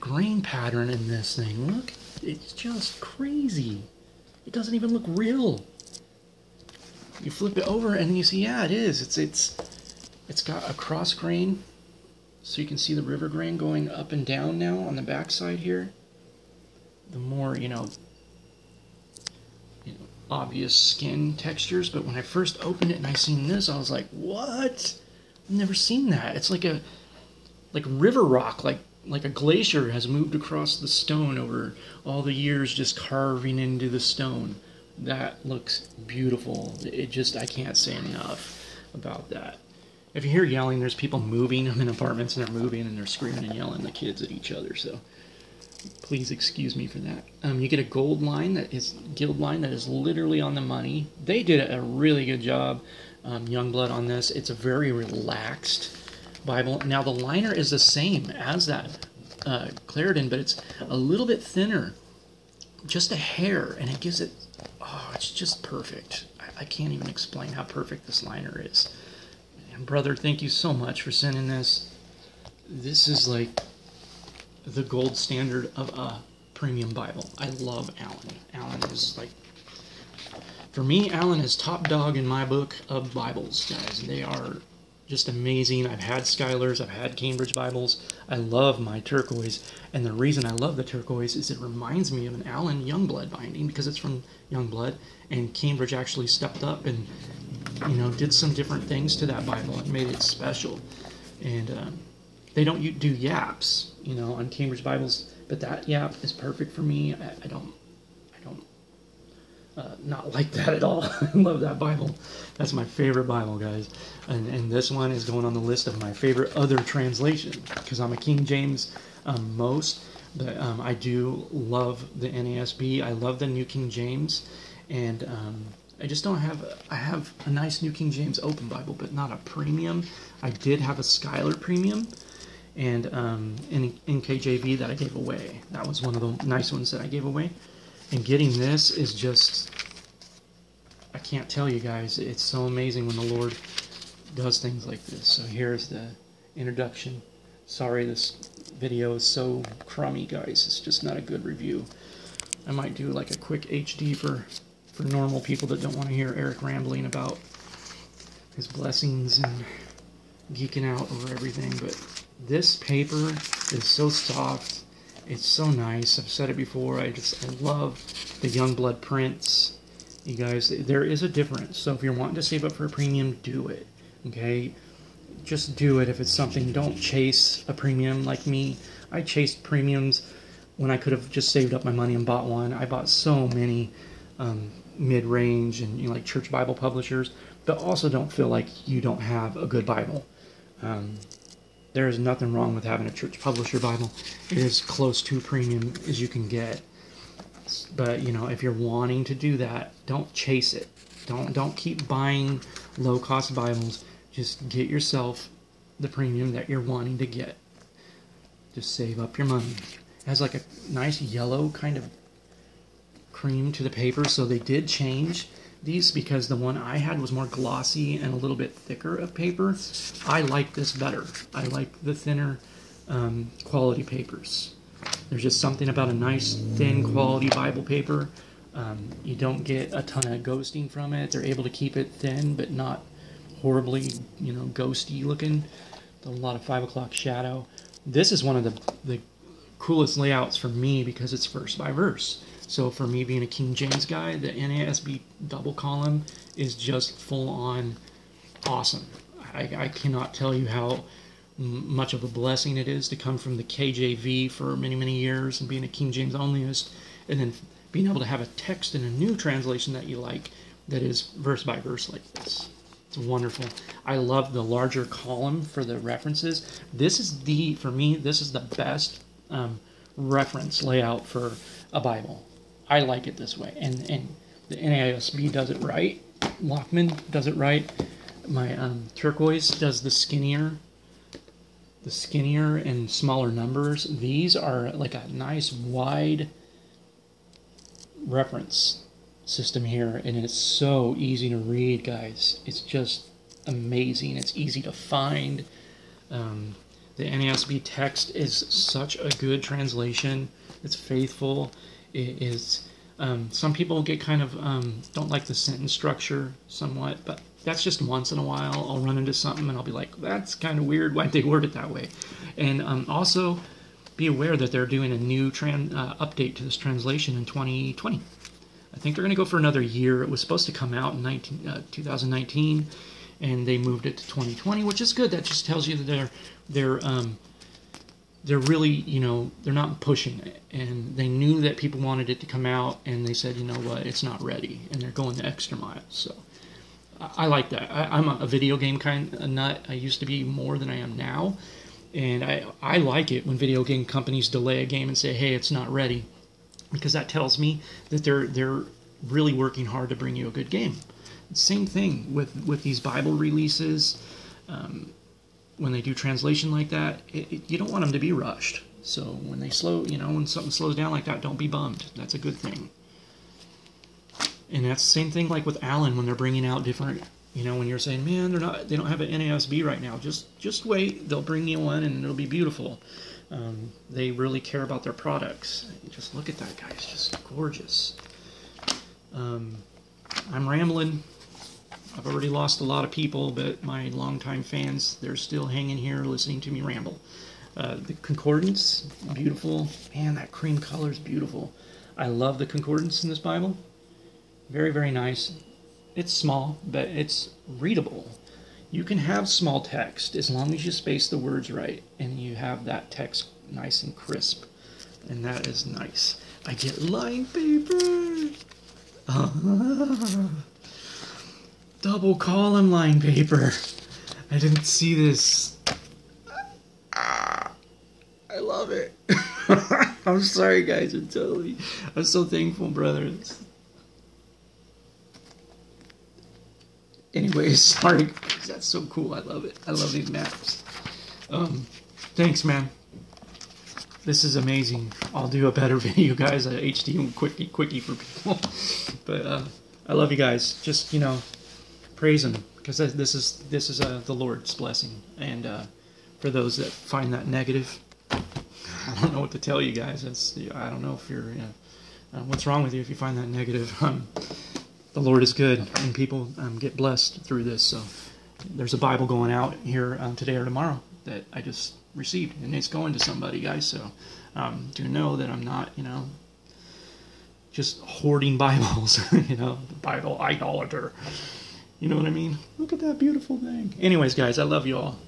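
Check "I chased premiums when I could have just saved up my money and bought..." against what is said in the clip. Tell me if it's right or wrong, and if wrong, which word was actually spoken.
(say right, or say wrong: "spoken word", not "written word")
right.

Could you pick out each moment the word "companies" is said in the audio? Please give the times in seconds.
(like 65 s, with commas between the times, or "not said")
344 s.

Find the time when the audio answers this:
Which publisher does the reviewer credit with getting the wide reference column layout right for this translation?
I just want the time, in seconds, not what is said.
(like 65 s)
276 s.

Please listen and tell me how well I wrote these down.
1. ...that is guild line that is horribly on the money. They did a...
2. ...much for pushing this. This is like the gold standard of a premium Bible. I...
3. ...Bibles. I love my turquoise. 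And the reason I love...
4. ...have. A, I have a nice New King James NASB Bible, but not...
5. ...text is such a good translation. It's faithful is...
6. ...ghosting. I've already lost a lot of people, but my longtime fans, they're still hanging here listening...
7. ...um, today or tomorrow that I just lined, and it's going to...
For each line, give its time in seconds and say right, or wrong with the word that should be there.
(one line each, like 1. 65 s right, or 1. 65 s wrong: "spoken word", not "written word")
1. 48 s wrong: "literally", not "horribly"
2. 70 s wrong: "sending", not "pushing"
3. 87 s right
4. 126 s wrong: "Open", not "NASB"
5. 297 s right
6. 380 s wrong: "rambling", not "ghosting"
7. 460 s wrong: "received", not "lined".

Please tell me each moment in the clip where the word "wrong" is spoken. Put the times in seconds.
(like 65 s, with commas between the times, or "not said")
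192 s, 452 s.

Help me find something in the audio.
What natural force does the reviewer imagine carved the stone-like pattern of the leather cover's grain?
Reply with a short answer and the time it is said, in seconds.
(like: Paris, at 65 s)
A glacier, at 29 s.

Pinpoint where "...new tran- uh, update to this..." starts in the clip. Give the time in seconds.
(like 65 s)
315 s.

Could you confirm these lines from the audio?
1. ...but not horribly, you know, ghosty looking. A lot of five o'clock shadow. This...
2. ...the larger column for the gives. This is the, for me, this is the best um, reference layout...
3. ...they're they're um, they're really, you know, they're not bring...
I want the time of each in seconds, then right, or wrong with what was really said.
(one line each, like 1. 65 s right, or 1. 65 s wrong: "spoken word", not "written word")
1. 232 s right
2. 264 s wrong: "references", not "gives"
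3. 326 s wrong: "pushing", not "bring".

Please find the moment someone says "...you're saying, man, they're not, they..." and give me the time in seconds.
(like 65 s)
367 s.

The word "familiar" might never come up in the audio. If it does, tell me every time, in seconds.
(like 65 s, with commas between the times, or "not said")
not said.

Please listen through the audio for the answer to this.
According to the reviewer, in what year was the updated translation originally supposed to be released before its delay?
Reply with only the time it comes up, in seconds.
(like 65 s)
321 s.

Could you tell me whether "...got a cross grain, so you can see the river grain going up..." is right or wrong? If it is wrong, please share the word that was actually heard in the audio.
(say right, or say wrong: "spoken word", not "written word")
right.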